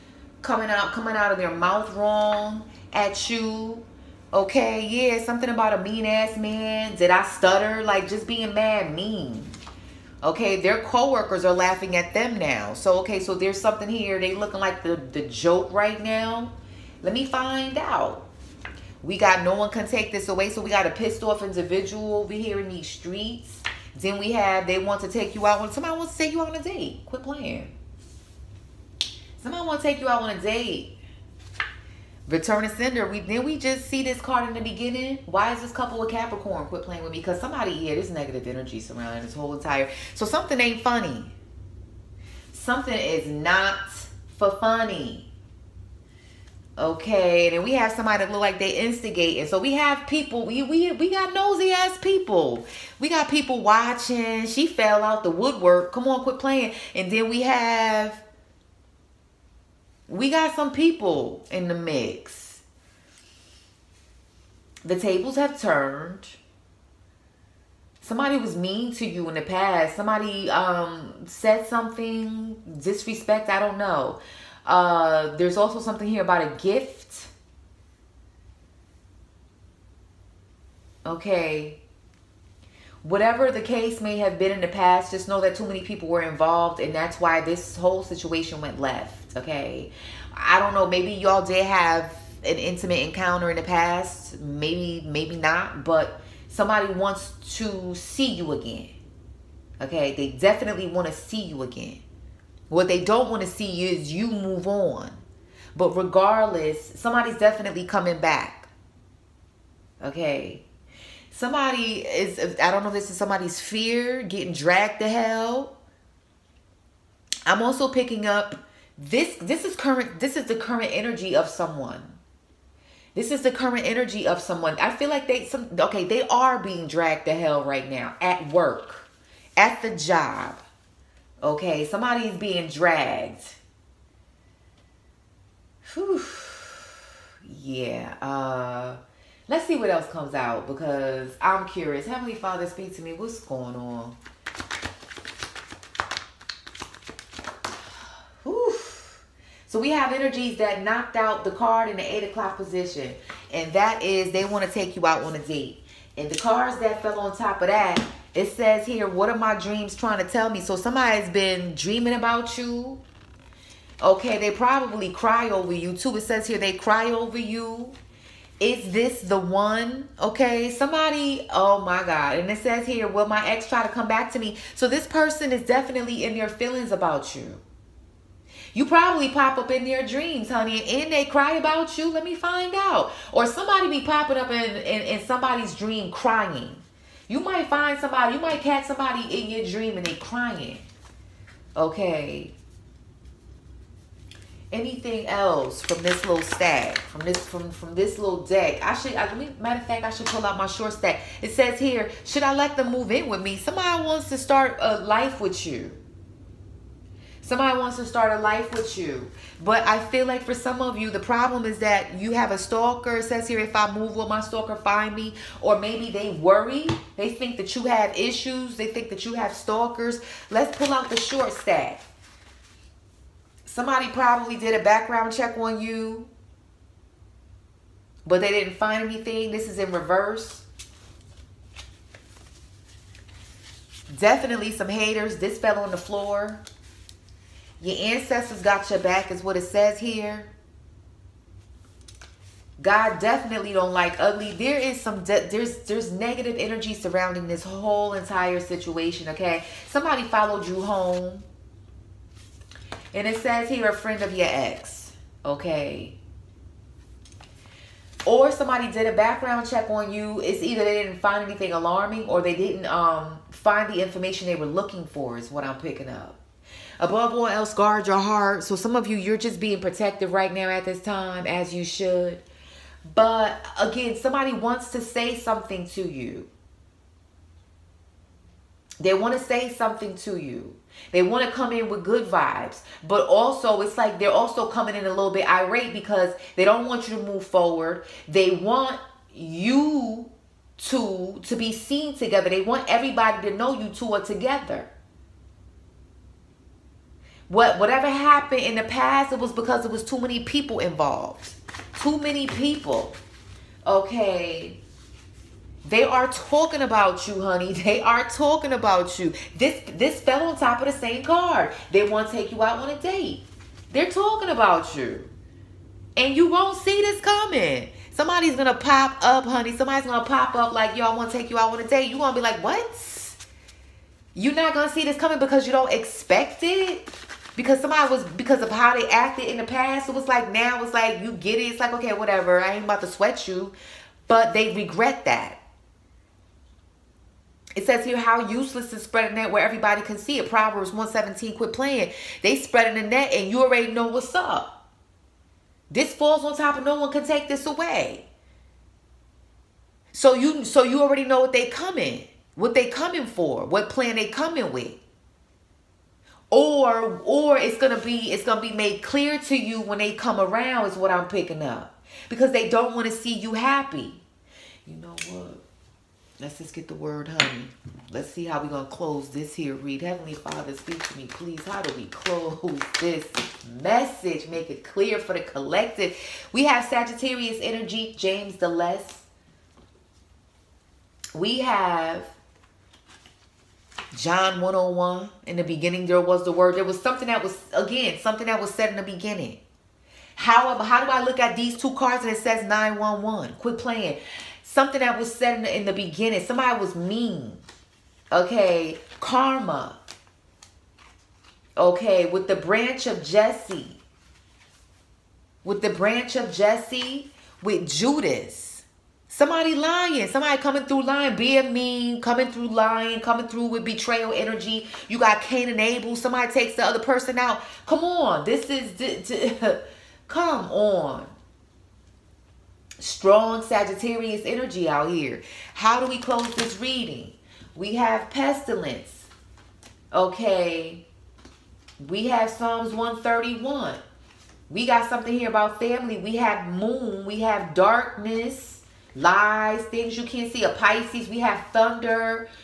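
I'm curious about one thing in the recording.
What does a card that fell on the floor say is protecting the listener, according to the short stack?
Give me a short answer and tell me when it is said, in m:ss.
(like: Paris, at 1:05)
Your ancestors, at 3:57.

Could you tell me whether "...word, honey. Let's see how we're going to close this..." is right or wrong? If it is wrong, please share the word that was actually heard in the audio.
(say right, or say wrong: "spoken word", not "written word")
right.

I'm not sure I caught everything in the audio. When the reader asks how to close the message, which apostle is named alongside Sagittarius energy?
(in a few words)
James the Less.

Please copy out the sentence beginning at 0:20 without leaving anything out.
So we got a pissed off individual over here in these streets.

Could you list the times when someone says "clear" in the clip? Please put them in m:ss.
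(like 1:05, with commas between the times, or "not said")
5:59, 6:14.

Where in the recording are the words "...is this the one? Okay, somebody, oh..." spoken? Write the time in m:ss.
2:48.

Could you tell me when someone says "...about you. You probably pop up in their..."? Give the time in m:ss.
2:56.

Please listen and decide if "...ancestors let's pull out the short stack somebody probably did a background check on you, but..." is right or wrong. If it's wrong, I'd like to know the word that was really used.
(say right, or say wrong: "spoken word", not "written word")
wrong: "stalkers", not "ancestors".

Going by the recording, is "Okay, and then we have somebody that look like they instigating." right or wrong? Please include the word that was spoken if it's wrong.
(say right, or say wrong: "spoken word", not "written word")
right.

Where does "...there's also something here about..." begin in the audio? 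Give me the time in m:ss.
1:15.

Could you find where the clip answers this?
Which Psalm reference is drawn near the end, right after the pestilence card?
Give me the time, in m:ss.
7:12.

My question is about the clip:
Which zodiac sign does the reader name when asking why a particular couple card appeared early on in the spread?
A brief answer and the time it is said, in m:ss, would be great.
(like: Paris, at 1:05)
Capricorn, at 0:36.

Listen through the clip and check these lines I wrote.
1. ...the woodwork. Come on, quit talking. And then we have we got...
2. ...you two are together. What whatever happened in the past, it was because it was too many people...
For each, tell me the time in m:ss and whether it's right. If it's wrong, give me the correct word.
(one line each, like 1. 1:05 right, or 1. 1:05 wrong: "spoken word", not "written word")
1. 0:55 wrong: "playing", not "talking"
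2. 4:53 right.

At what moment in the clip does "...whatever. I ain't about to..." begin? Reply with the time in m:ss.
5:32.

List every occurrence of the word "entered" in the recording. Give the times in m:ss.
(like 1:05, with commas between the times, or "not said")
not said.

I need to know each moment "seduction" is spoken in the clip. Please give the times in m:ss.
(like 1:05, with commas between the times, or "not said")
not said.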